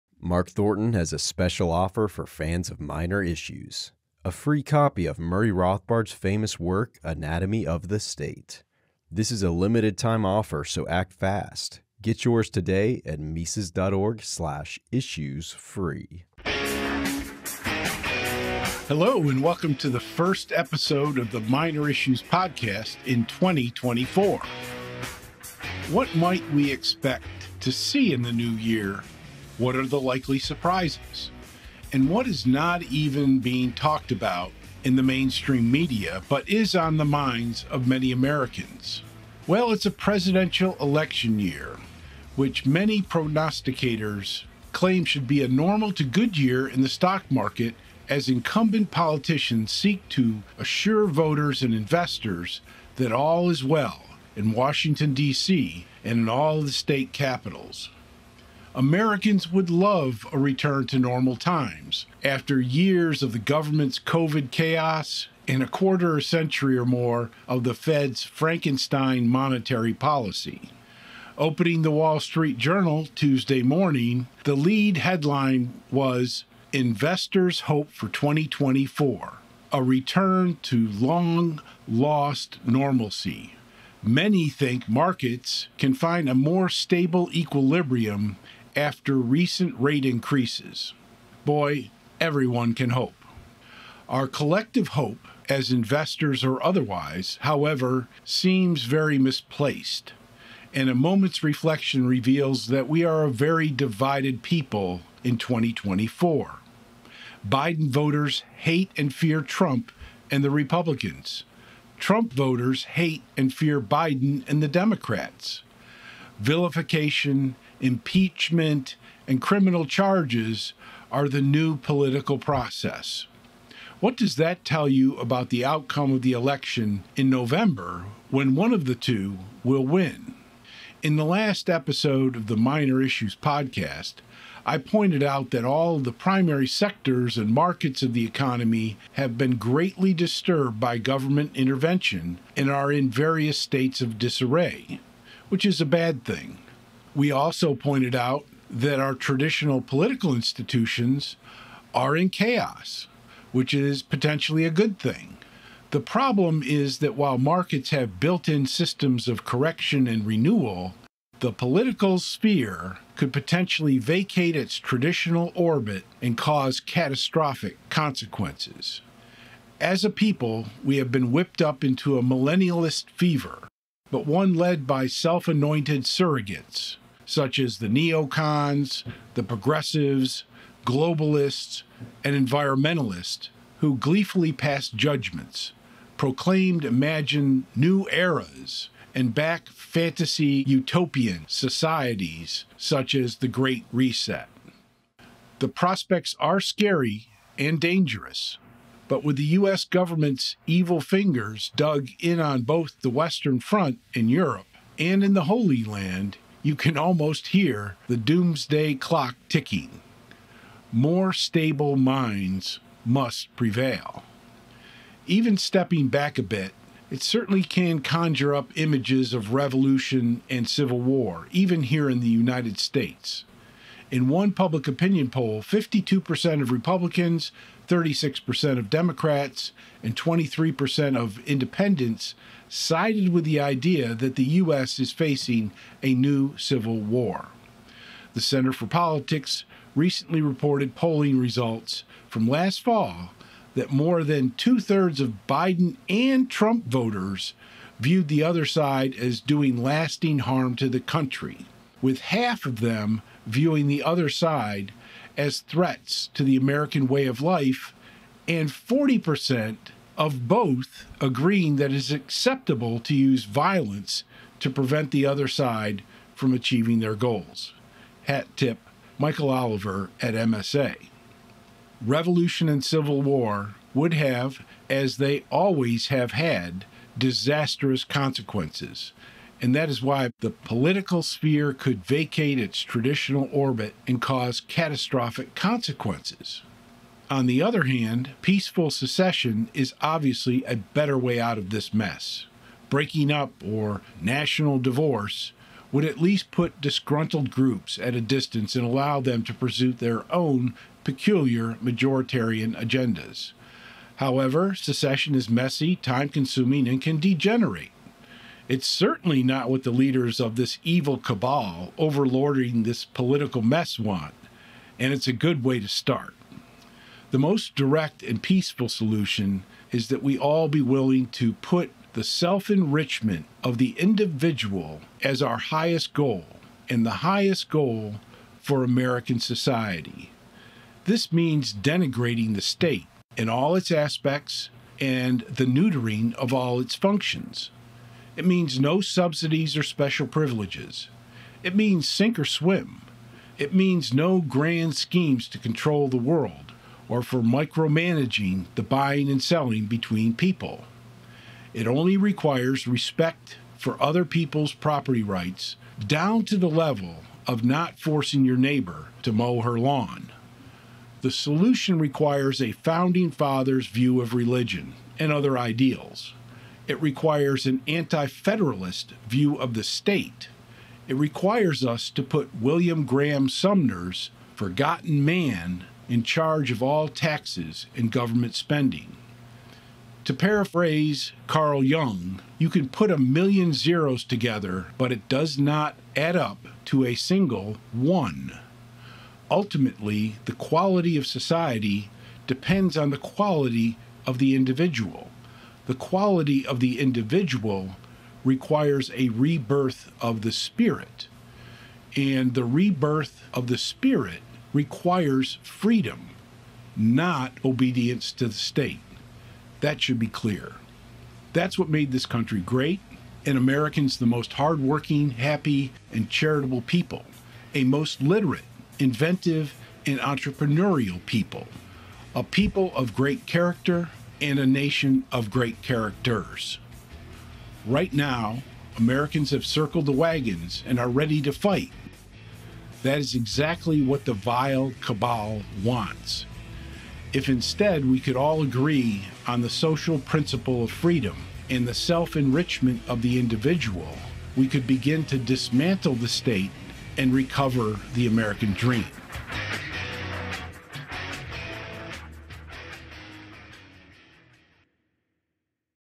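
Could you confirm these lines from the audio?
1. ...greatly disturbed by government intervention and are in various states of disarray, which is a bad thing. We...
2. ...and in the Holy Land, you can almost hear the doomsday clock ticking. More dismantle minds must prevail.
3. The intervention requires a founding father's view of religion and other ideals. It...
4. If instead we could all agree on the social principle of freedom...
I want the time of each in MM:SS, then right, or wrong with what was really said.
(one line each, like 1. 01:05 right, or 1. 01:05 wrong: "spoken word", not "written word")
1. 02:19 right
2. 03:24 wrong: "stable", not "dismantle"
3. 06:01 wrong: "solution", not "intervention"
4. 07:17 right.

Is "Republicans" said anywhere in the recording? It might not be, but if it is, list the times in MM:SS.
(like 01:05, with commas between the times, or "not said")
01:50, 03:46.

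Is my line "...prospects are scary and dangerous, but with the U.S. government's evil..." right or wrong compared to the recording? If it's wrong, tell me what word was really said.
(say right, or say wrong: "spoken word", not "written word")
right.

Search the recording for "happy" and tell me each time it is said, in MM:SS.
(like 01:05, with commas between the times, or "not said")
06:55.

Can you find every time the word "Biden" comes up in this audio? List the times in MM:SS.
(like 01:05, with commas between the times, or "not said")
01:47, 01:53, 04:05.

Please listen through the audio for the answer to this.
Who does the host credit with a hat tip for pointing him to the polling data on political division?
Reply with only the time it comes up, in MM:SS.
04:29.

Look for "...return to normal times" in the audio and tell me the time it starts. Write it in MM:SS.
01:00.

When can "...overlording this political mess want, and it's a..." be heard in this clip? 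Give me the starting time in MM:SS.
05:11.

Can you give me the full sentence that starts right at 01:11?
Opening the Wall Street Journal Tuesday morning, the lead headline was Investors Hope for 2024 A Return to Long Lost Normalcy.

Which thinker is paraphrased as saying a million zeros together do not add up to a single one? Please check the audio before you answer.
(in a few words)
Carl Jung.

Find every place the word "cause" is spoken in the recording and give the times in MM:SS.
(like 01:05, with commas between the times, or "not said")
02:46, 04:44.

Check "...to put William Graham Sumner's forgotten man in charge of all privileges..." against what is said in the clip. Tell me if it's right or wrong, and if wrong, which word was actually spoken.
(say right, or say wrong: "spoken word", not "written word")
wrong: "taxes", not "privileges".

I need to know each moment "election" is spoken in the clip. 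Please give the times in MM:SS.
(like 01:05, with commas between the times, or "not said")
00:40, 02:06.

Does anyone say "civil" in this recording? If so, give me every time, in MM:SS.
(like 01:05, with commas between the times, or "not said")
03:40, 03:56, 04:32.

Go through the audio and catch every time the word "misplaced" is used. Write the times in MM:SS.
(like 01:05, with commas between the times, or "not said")
01:39.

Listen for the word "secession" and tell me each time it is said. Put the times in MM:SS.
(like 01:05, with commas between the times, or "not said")
04:48, 05:04.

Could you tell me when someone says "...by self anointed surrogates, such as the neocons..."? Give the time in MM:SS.
02:54.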